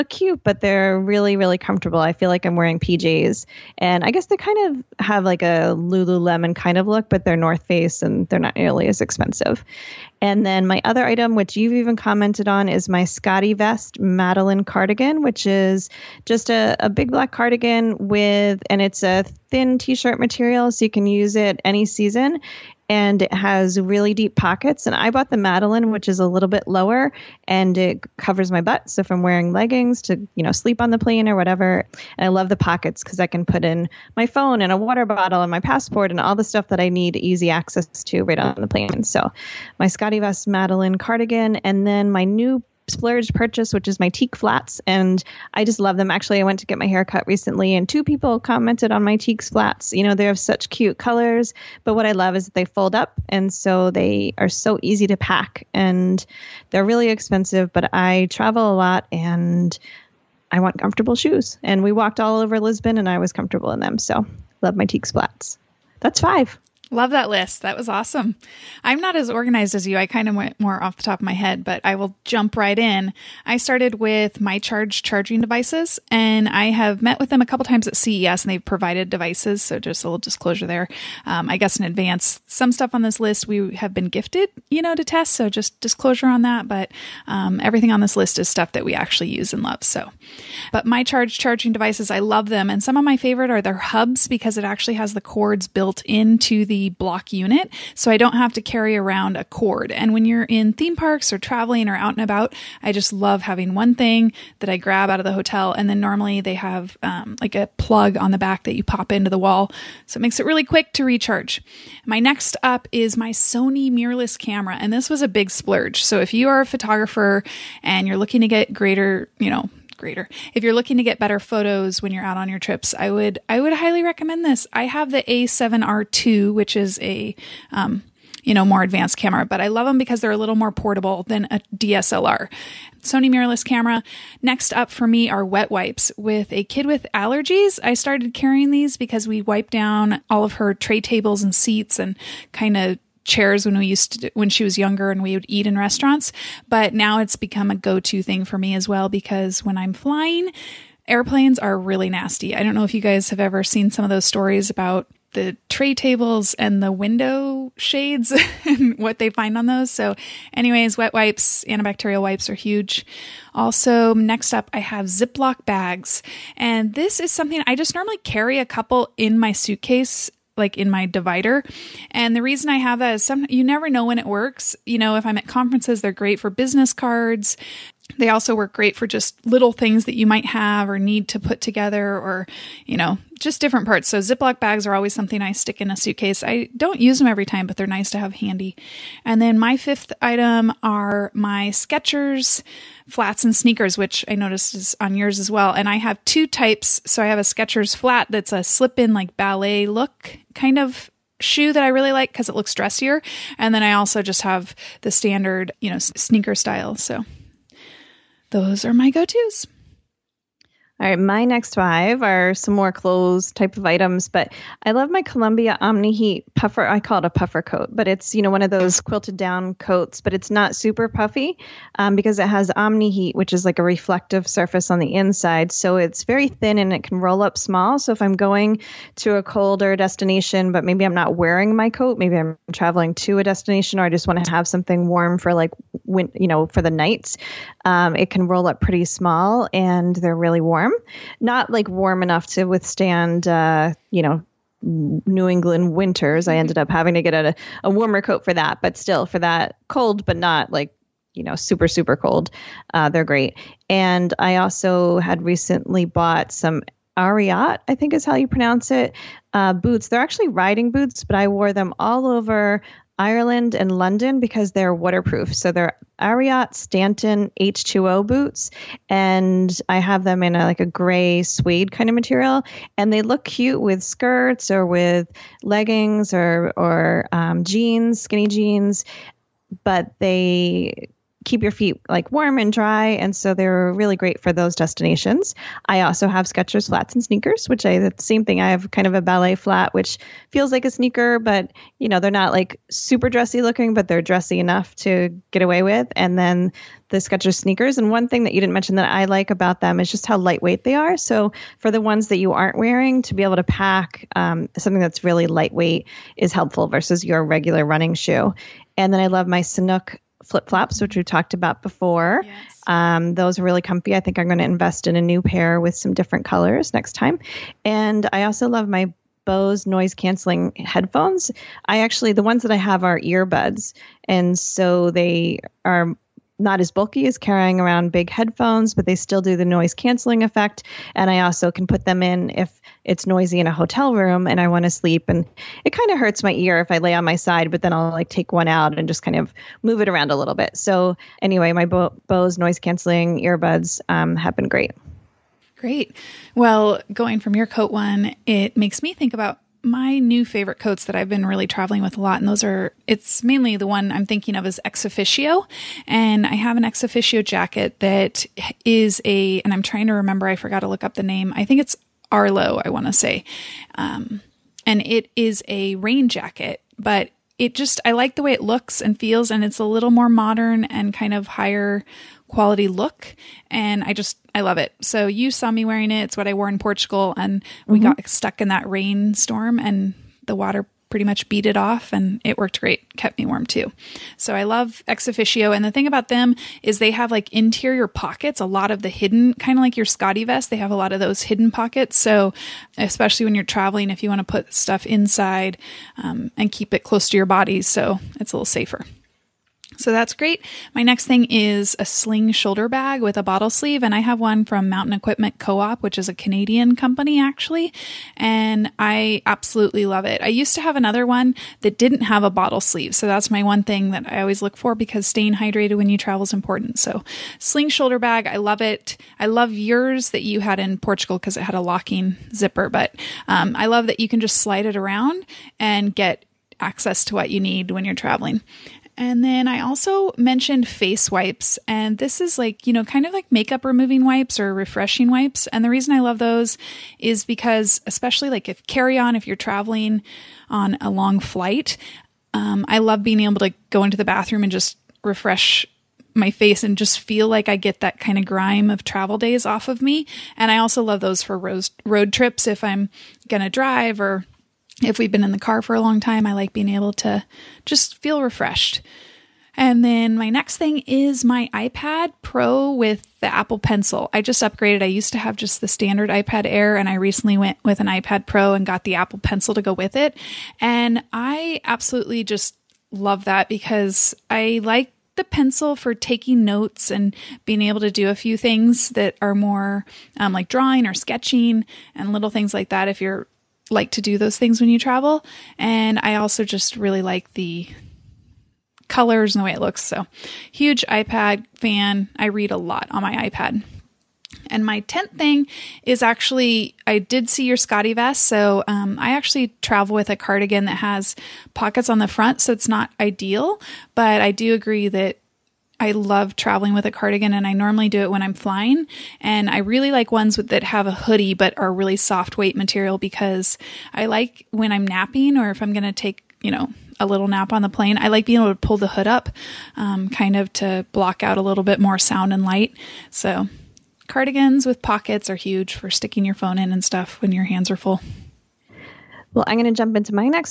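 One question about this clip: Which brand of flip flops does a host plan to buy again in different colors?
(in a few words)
Sanuk.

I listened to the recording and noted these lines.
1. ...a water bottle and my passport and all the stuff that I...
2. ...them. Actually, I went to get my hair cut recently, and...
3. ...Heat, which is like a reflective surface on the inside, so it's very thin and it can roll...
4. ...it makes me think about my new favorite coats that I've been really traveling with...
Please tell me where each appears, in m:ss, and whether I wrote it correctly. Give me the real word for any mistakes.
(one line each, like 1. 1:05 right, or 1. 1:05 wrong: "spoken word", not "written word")
1. 0:34 right
2. 0:45 right
3. 3:43 right
4. 5:48 right.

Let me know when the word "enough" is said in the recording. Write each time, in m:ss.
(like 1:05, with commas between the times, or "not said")
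4:02, 4:54.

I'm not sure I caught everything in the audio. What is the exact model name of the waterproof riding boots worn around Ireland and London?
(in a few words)
Ariat Stanton H2O.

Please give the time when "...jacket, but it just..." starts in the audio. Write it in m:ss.
6:06.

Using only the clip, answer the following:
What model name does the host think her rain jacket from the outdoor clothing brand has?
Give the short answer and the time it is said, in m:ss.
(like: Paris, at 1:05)
Arlo, at 6:02.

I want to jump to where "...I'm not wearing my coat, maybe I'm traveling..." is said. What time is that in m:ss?
3:51.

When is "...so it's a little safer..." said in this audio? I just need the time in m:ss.
6:37.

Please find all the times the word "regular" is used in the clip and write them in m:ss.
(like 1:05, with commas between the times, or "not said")
5:07.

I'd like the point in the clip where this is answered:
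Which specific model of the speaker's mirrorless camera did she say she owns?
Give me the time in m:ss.
2:05.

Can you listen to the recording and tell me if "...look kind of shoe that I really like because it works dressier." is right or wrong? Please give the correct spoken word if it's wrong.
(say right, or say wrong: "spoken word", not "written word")
wrong: "looks", not "works".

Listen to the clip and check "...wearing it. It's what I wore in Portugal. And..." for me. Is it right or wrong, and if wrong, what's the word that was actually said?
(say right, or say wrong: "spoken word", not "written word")
right.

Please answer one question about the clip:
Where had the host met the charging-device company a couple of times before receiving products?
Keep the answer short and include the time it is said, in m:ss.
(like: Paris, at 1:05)
CES, at 1:17.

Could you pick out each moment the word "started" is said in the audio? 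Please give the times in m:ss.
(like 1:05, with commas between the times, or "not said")
1:13, 2:17.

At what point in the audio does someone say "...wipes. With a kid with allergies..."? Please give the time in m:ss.
2:15.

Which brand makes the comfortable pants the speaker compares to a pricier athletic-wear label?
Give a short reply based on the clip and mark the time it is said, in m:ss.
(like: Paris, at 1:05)
North Face, at 0:07.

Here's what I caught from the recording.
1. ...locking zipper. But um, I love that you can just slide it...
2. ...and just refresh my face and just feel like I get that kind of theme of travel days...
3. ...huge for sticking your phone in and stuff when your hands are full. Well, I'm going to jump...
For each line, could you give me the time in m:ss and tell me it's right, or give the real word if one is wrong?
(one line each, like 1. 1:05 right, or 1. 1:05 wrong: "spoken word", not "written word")
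1. 7:01 right
2. 7:24 wrong: "grime", not "theme"
3. 8:45 right.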